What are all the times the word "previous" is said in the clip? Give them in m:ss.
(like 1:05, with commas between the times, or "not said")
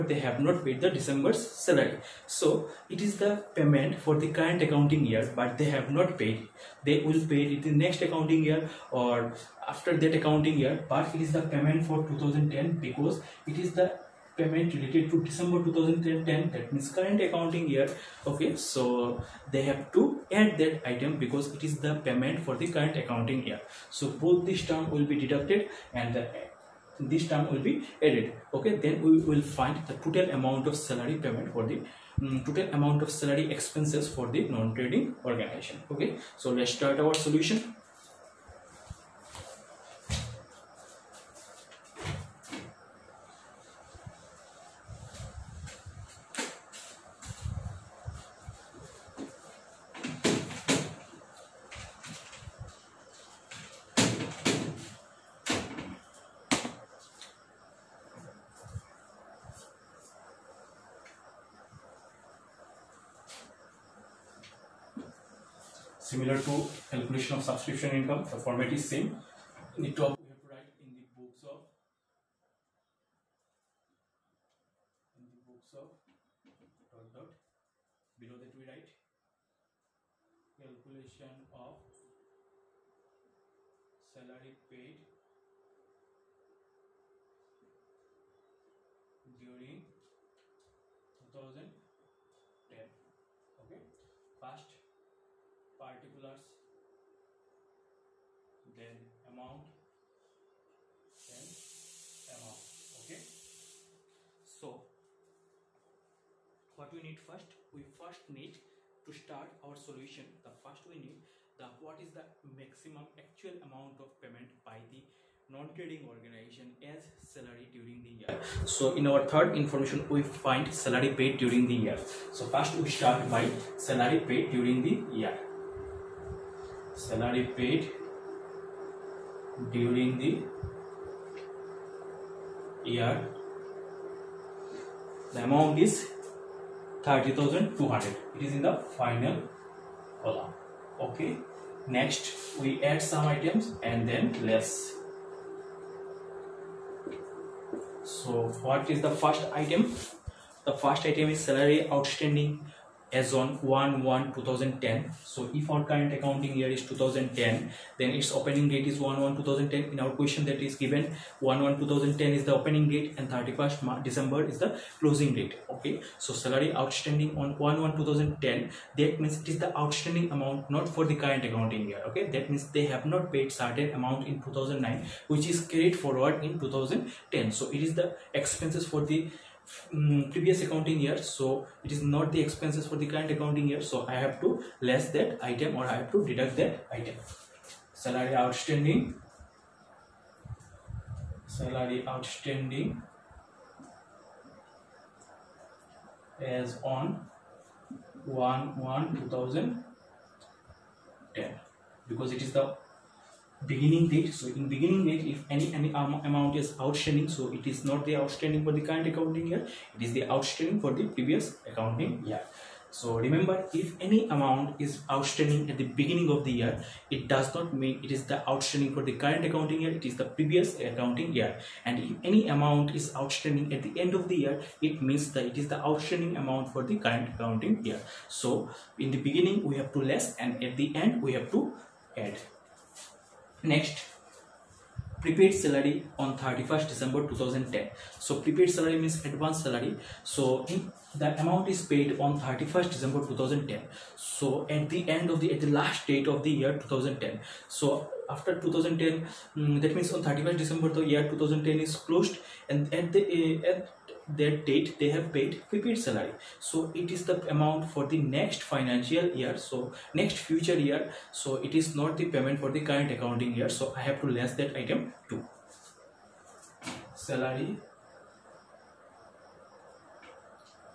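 3:00, 3:31, 3:40.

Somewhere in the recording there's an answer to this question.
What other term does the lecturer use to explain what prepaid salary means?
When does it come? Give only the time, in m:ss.
3:59.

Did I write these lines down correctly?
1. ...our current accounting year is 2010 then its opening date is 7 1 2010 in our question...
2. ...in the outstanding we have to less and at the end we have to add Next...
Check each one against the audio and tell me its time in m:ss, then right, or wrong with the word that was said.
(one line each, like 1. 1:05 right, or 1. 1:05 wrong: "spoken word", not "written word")
1. 2:35 wrong: "1", not "7"
2. 3:48 wrong: "beginning", not "outstanding".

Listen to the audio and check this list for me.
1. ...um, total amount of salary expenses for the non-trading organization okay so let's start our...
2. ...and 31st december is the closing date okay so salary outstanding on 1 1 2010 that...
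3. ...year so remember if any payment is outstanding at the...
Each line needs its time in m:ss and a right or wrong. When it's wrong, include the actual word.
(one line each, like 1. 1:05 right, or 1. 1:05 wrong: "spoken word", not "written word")
1. 0:31 right
2. 2:43 right
3. 3:32 wrong: "amount", not "payment".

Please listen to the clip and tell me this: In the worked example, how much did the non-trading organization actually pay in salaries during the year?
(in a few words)
30,200.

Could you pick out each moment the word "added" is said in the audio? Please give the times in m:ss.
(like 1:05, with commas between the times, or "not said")
0:28.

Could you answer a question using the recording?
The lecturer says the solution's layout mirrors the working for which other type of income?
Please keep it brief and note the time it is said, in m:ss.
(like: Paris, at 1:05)
Subscription income, at 1:07.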